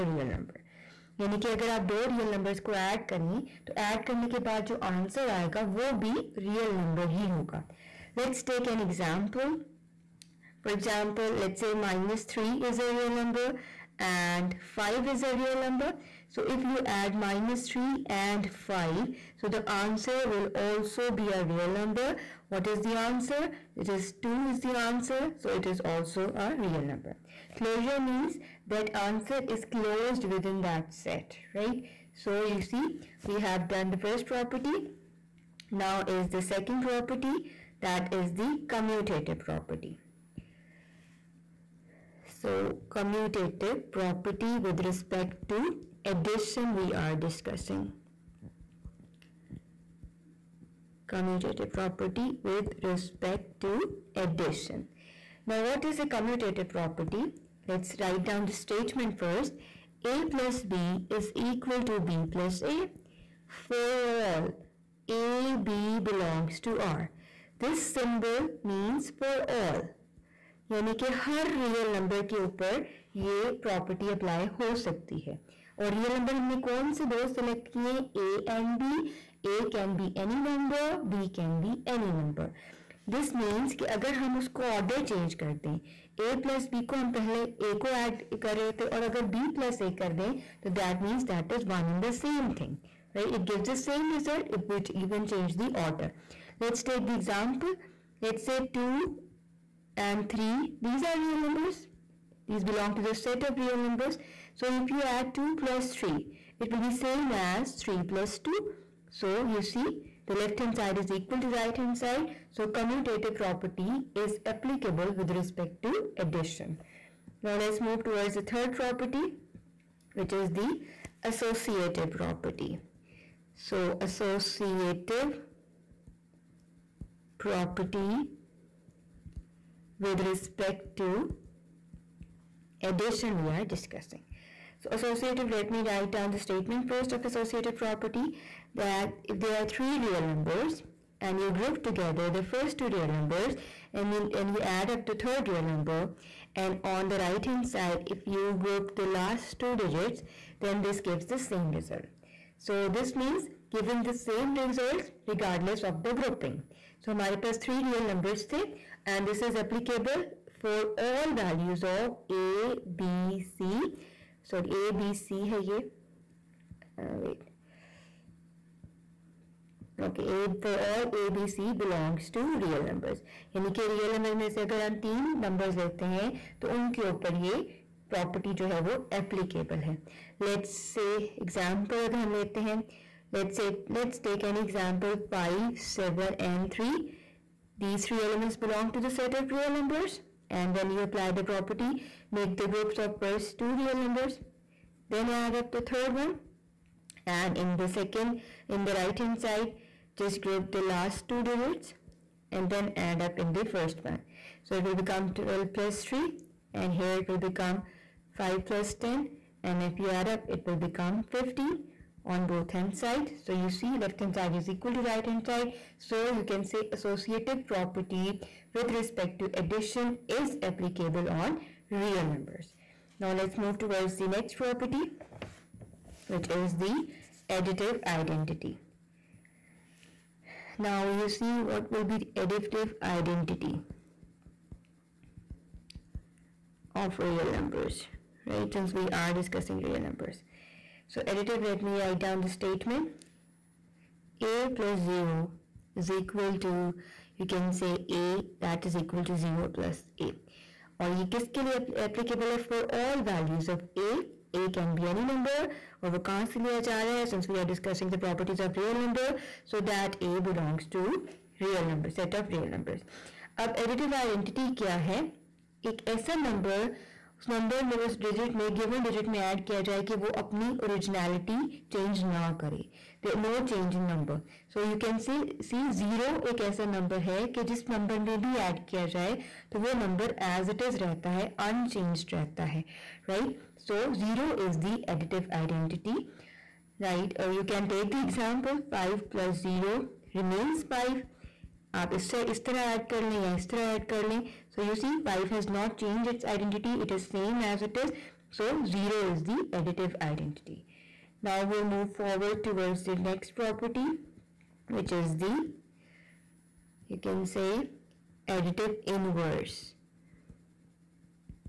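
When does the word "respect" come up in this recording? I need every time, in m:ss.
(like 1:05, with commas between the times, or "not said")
0:44, 0:52, 1:55, 2:10, 3:38.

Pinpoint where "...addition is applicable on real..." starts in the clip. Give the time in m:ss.
3:39.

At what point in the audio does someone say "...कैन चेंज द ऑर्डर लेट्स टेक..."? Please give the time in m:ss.
1:35.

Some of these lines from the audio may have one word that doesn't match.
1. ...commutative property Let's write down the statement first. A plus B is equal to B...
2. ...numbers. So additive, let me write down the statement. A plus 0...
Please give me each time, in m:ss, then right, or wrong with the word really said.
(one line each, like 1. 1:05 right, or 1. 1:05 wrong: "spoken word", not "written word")
1. 0:56 right
2. 4:00 right.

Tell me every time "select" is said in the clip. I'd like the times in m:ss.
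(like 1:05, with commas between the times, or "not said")
not said.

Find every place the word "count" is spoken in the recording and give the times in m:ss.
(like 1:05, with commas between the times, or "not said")
not said.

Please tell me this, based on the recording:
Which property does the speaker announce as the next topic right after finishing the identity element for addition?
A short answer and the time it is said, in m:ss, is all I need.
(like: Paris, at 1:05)
additive inverse, at 5:08.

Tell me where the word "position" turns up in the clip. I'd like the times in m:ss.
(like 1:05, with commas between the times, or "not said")
not said.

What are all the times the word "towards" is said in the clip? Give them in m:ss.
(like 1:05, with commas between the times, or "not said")
1:58, 3:43, 5:02.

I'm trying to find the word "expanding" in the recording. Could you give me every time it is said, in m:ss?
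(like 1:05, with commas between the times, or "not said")
not said.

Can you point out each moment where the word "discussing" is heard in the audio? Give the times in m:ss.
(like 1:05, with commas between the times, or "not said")
0:47, 2:13, 3:59.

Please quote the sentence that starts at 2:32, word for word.
So this means giving the same results regardless of the grouping.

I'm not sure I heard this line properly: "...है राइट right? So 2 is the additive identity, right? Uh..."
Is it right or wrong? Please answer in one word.
wrong.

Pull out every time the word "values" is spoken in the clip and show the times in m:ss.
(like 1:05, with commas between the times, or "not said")
2:41, 4:13.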